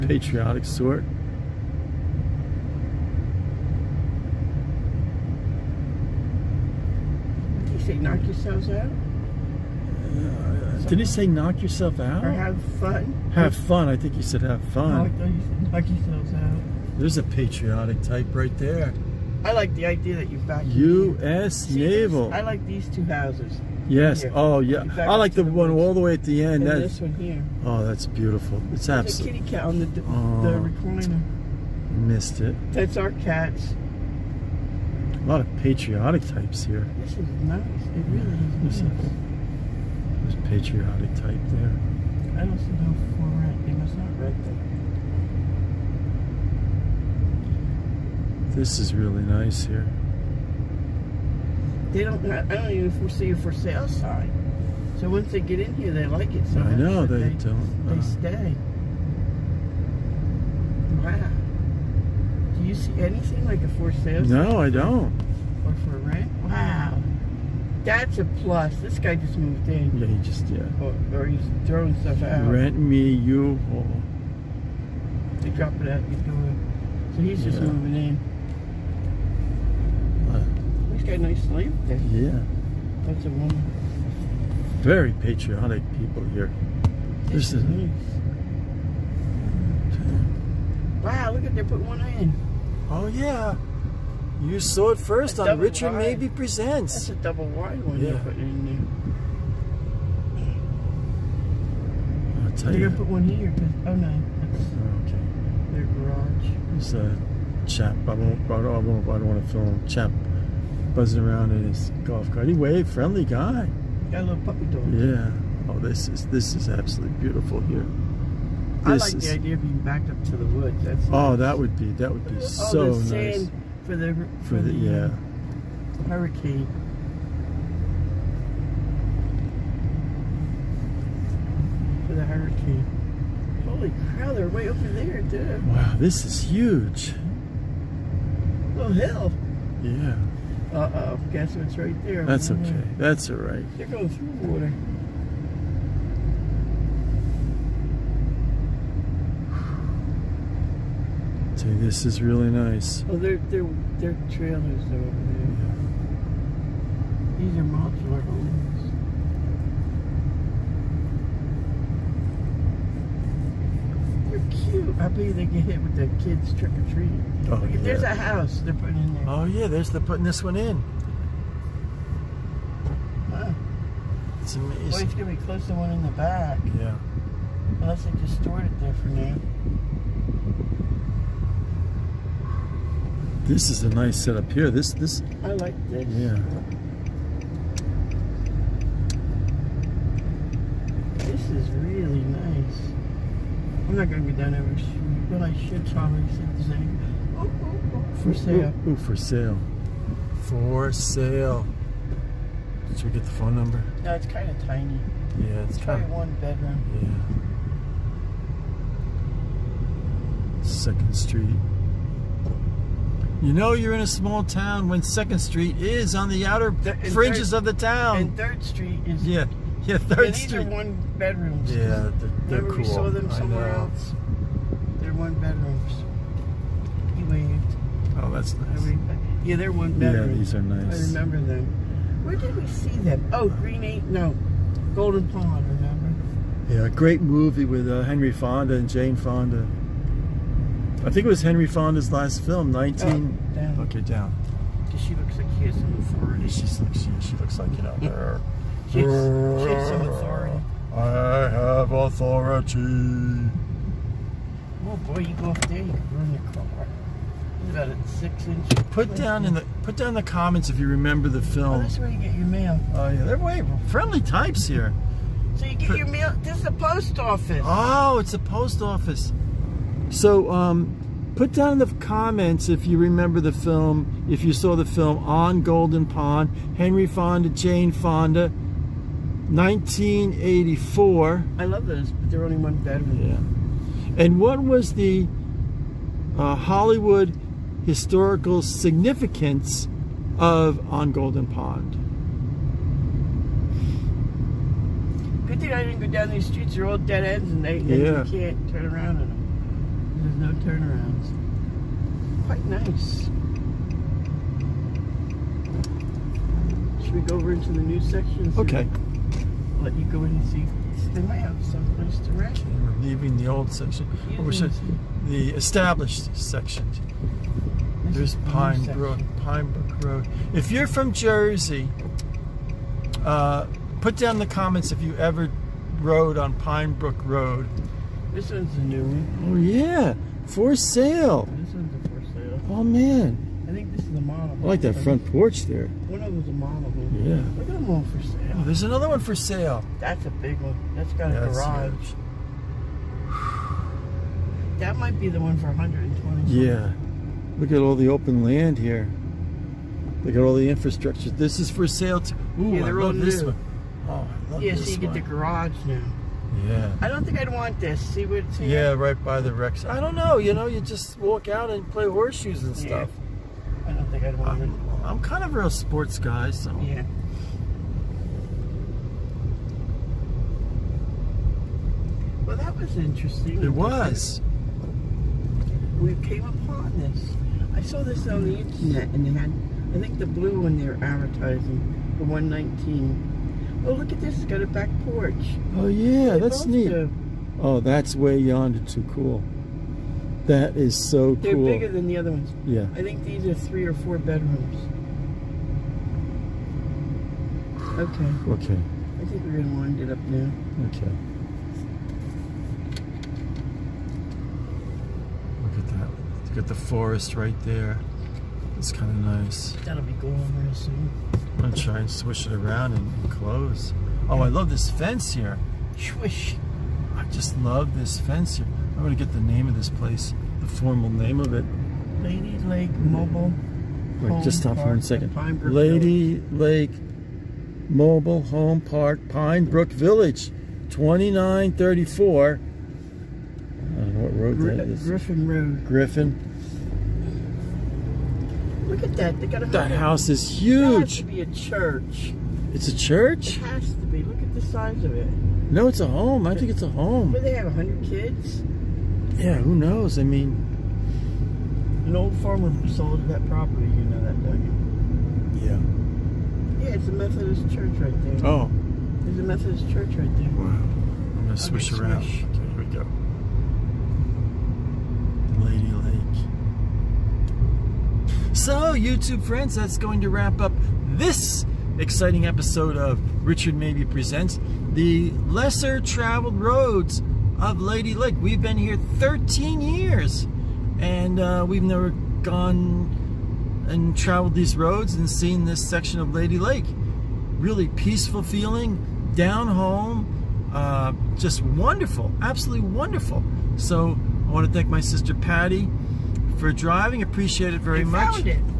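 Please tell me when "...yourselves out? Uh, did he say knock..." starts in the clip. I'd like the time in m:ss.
0:08.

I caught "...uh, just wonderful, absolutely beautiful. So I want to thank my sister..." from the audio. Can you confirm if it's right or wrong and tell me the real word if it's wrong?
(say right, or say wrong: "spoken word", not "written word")
wrong: "wonderful", not "beautiful".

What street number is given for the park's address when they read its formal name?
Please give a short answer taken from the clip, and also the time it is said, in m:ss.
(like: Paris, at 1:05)
2934, at 7:10.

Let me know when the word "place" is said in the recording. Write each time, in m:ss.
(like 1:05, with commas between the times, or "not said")
4:19, 5:11, 6:59.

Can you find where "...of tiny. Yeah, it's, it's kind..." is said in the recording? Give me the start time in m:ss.
3:24.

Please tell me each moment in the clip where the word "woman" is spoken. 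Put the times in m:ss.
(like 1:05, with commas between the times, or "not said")
1:23.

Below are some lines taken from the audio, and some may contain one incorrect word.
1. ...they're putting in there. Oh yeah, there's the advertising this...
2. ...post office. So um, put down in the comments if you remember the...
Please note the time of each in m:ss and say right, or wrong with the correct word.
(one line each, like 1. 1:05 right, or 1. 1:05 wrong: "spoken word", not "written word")
1. 2:48 wrong: "putting", not "advertising"
2. 4:28 right.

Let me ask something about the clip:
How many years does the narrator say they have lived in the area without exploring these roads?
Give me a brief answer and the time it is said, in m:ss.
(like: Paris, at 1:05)
13, at 7:59.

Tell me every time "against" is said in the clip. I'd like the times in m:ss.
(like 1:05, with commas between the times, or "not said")
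not said.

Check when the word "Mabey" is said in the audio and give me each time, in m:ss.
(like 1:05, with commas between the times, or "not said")
1:35, 7:53.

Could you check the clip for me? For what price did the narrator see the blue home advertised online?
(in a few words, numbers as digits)
119.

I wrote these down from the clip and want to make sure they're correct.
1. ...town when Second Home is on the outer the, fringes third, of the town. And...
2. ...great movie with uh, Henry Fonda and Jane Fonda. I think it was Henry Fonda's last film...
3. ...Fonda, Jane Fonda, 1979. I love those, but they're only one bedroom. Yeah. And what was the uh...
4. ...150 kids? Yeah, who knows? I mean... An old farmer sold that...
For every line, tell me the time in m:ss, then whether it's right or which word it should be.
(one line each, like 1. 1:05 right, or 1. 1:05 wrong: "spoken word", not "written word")
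1. 3:34 wrong: "Street", not "Home"
2. 3:56 right
3. 4:37 wrong: "1984", not "1979"
4. 7:27 wrong: "100", not "150".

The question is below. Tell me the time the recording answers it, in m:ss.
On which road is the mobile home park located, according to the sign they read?
7:15.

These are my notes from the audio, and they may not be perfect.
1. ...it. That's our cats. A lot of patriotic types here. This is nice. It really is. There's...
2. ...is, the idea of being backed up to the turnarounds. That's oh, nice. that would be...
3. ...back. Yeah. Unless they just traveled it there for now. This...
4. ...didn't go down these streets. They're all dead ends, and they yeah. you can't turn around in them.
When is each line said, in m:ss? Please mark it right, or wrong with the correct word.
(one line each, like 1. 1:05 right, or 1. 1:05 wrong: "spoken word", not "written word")
1. 0:32 right
2. 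1:59 wrong: "woods", not "turnarounds"
3. 2:56 wrong: "stored", not "traveled"
4. 4:55 right.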